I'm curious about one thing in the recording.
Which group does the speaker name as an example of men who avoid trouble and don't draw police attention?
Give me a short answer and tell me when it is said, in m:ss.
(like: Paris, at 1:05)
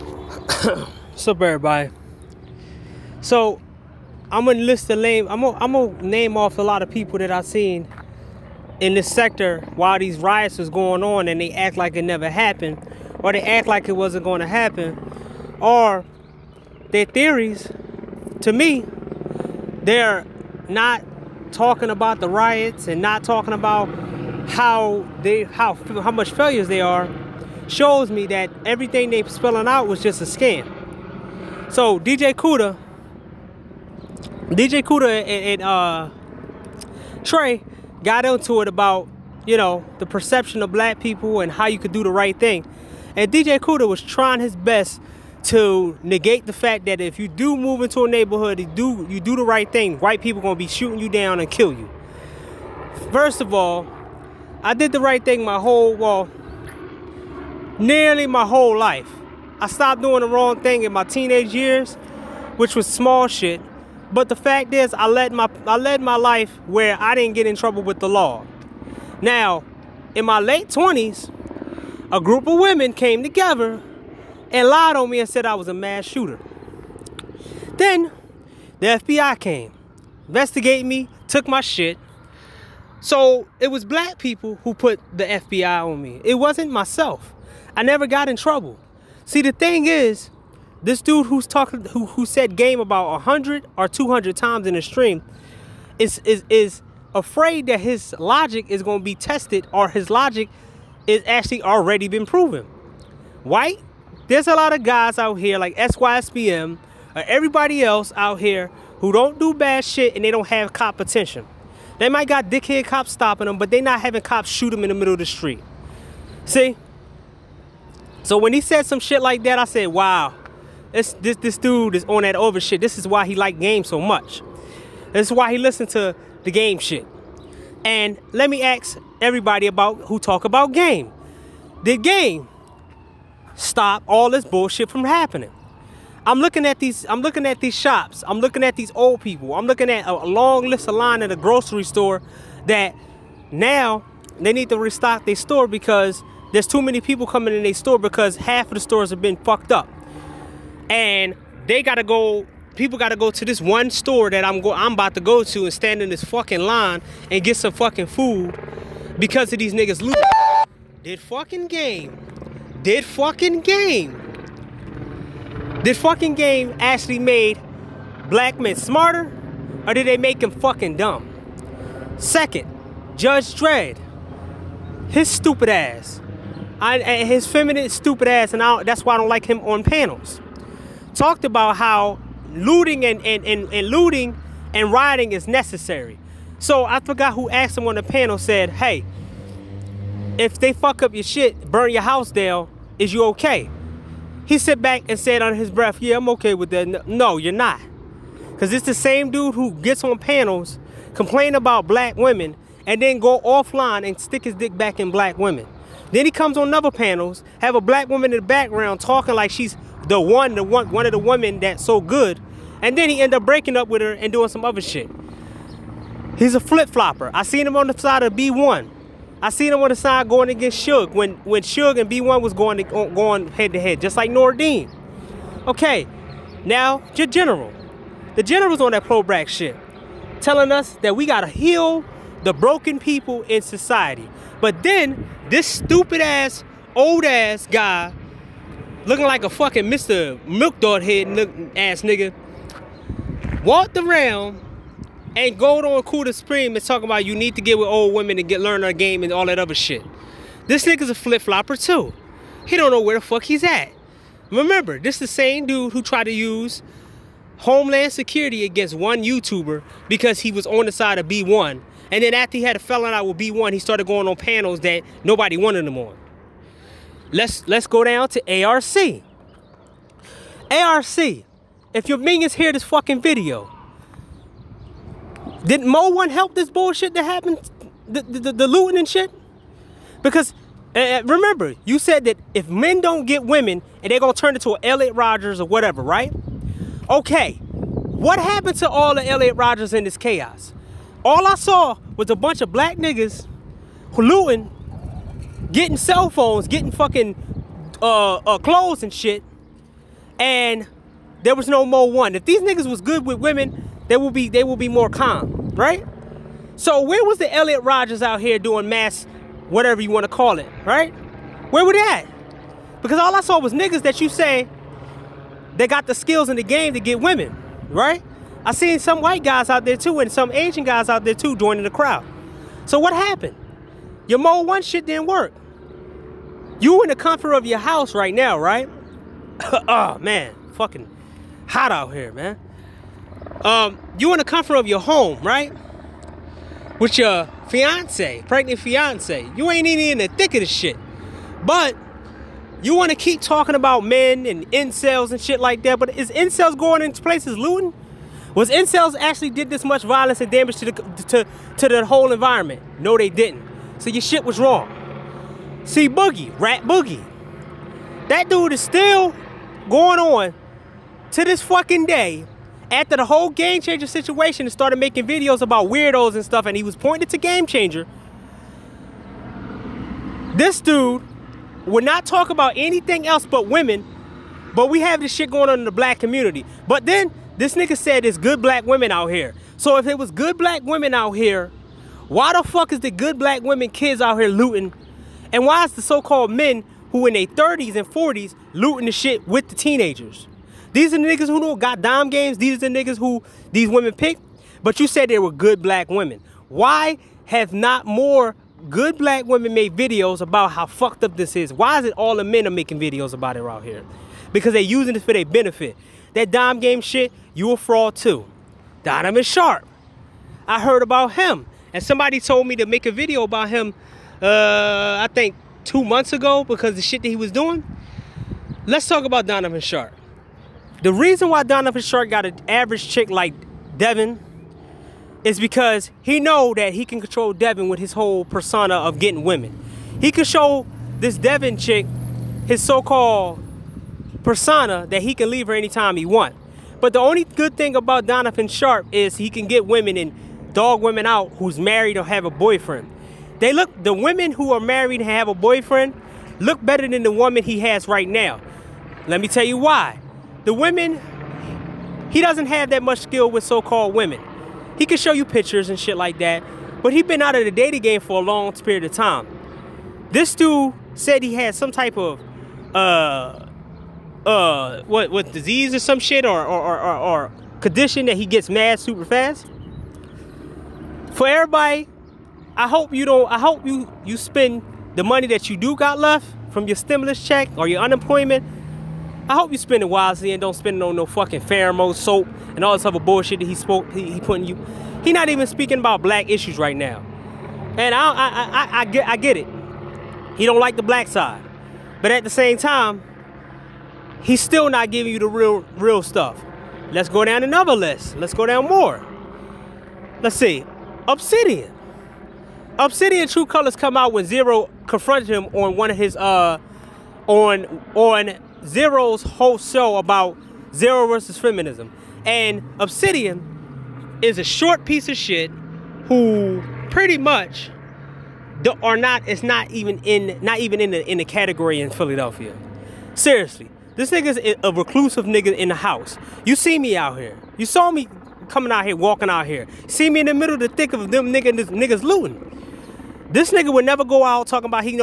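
SYSBM, at 1:45.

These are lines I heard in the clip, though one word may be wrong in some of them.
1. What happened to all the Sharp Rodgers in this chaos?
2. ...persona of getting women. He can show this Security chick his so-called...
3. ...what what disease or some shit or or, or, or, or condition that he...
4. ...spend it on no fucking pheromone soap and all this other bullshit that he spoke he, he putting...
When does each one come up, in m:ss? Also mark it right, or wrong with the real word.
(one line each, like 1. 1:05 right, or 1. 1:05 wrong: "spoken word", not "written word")
1. 4:47 wrong: "Elliot", not "Sharp"
2. 7:08 wrong: "Devin", not "Security"
3. 7:45 right
4. 8:00 right.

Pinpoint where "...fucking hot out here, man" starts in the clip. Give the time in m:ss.
5:30.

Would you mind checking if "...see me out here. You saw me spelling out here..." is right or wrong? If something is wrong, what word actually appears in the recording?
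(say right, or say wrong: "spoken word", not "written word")
wrong: "coming", not "spelling".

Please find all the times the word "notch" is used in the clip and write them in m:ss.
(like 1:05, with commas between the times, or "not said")
not said.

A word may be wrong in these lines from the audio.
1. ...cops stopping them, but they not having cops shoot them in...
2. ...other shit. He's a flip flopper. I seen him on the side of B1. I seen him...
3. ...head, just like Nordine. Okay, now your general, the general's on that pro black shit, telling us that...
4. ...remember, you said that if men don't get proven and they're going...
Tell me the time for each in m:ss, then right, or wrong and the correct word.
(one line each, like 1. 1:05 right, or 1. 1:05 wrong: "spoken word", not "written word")
1. 1:52 right
2. 3:34 right
3. 3:43 right
4. 4:41 wrong: "women", not "proven".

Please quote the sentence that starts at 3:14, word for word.
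He sat back and said under his breath, yeah, I'm okay with that.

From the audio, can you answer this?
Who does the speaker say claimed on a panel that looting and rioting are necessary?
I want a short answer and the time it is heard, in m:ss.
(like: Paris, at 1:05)
Judge Dredd, at 2:53.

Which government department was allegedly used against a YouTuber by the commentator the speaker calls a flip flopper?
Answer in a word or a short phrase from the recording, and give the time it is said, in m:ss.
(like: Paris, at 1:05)
Homeland Security, at 4:17.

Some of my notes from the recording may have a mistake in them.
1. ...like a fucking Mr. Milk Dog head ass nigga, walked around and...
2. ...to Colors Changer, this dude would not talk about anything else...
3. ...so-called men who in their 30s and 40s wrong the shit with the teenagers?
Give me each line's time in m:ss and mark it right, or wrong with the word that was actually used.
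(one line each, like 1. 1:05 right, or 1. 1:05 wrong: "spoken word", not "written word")
1. 3:59 right
2. 6:07 wrong: "Game", not "Colors"
3. 6:26 wrong: "looting", not "wrong".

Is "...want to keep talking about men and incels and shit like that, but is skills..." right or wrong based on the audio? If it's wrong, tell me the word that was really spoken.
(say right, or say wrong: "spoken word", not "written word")
wrong: "incels", not "skills".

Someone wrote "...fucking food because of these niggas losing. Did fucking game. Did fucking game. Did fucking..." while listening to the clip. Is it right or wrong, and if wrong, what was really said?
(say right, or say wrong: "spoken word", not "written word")
right.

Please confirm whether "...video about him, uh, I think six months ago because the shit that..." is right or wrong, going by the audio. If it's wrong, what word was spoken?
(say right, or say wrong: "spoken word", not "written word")
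wrong: "two", not "six".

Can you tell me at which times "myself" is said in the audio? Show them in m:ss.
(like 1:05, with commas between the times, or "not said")
1:26.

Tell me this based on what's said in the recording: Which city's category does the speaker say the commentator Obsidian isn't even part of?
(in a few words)
Philadelphia.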